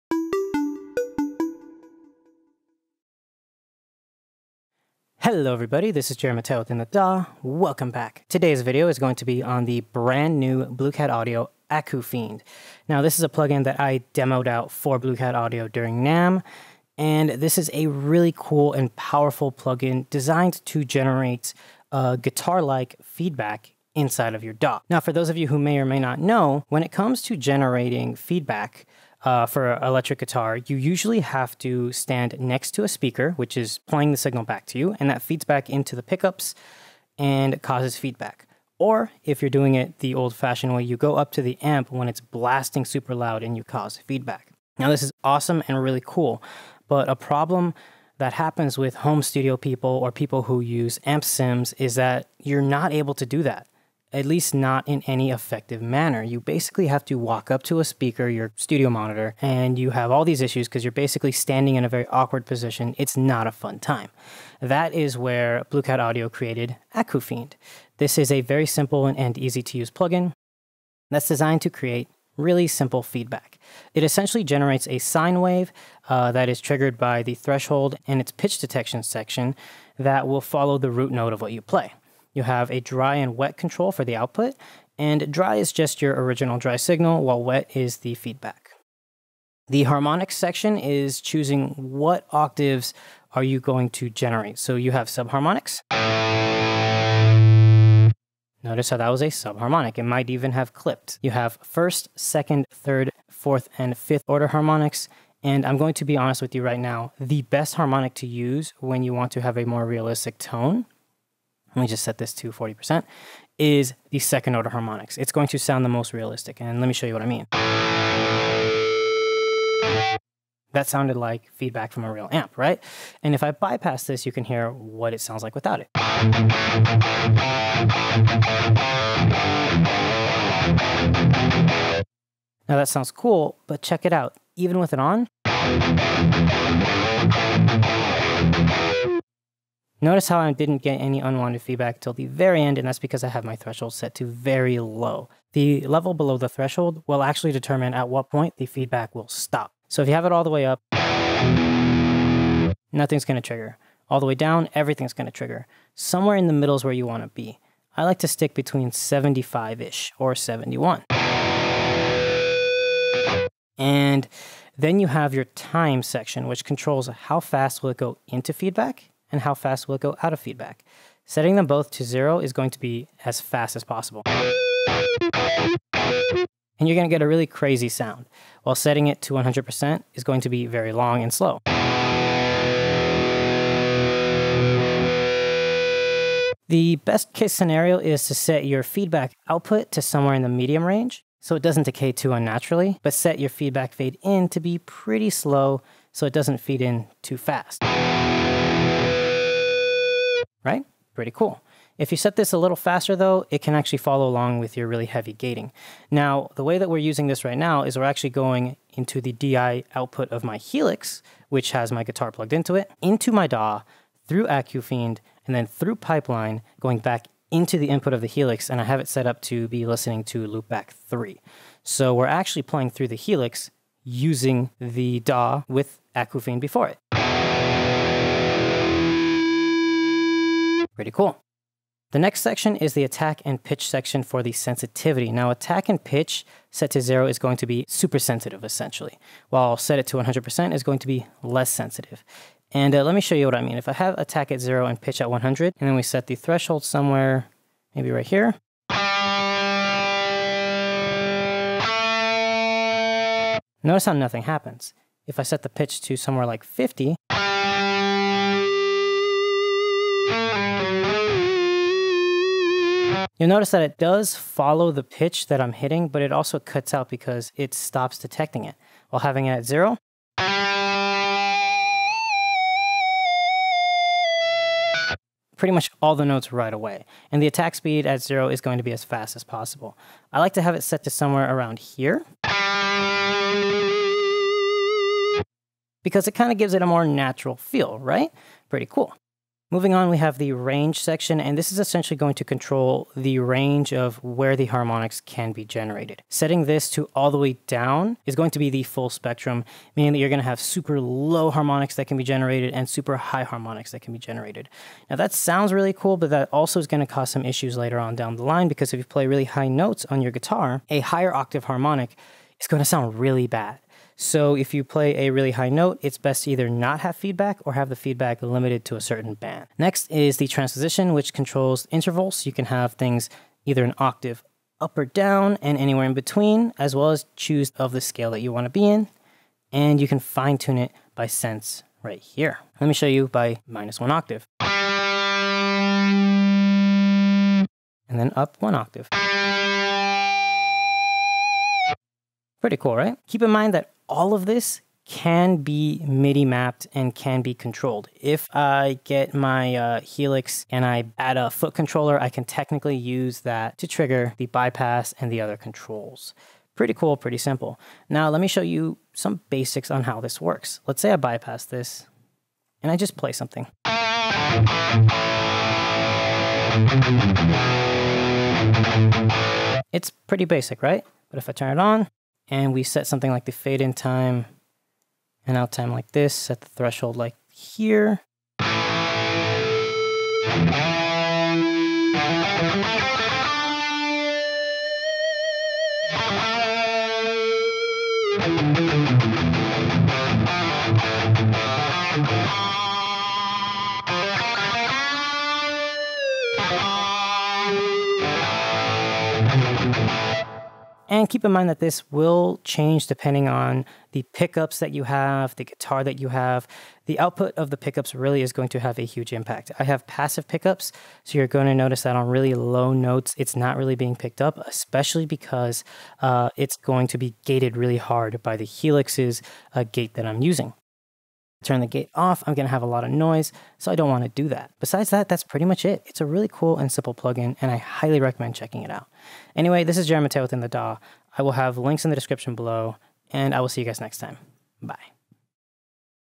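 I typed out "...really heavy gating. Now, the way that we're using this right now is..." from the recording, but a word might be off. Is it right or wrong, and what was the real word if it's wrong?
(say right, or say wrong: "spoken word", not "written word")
right.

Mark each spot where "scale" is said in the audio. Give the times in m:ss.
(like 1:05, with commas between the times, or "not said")
5:28.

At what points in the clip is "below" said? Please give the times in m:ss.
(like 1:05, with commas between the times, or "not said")
2:26, 7:12.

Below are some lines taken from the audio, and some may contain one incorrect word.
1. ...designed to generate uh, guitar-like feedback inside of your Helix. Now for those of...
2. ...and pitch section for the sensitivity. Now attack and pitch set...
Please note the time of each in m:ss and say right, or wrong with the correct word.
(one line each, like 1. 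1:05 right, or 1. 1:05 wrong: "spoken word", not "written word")
1. 0:20 wrong: "DAW", not "Helix"
2. 3:53 right.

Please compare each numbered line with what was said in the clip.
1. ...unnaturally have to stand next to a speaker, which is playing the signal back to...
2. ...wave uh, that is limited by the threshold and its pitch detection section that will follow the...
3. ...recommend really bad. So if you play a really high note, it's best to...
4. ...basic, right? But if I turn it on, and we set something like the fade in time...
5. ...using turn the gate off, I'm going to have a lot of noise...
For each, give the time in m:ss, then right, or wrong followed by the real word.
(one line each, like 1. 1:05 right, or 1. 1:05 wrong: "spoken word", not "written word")
1. 0:30 wrong: "usually", not "unnaturally"
2. 1:15 wrong: "triggered", not "limited"
3. 5:12 wrong: "sound", not "recommend"
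4. 6:10 right
5. 7:00 right.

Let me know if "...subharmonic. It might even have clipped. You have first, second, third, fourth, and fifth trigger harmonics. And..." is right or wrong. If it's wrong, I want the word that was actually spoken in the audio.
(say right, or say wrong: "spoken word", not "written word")
wrong: "order", not "trigger".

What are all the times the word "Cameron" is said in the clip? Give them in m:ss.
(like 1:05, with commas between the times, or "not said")
not said.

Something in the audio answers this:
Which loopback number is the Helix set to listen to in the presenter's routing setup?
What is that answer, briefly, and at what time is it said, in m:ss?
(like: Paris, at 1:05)
3, at 3:40.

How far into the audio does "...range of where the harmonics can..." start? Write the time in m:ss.
4:53.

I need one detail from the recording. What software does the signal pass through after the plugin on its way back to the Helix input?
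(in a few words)
Pipeline.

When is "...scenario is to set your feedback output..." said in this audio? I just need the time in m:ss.
3:07.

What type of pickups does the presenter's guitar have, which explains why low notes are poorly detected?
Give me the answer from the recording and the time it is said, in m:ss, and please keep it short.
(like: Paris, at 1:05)
passive, at 6:50.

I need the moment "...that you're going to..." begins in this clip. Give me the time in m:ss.
5:00.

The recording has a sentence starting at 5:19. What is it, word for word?
Next is the transposition, which controls intervals.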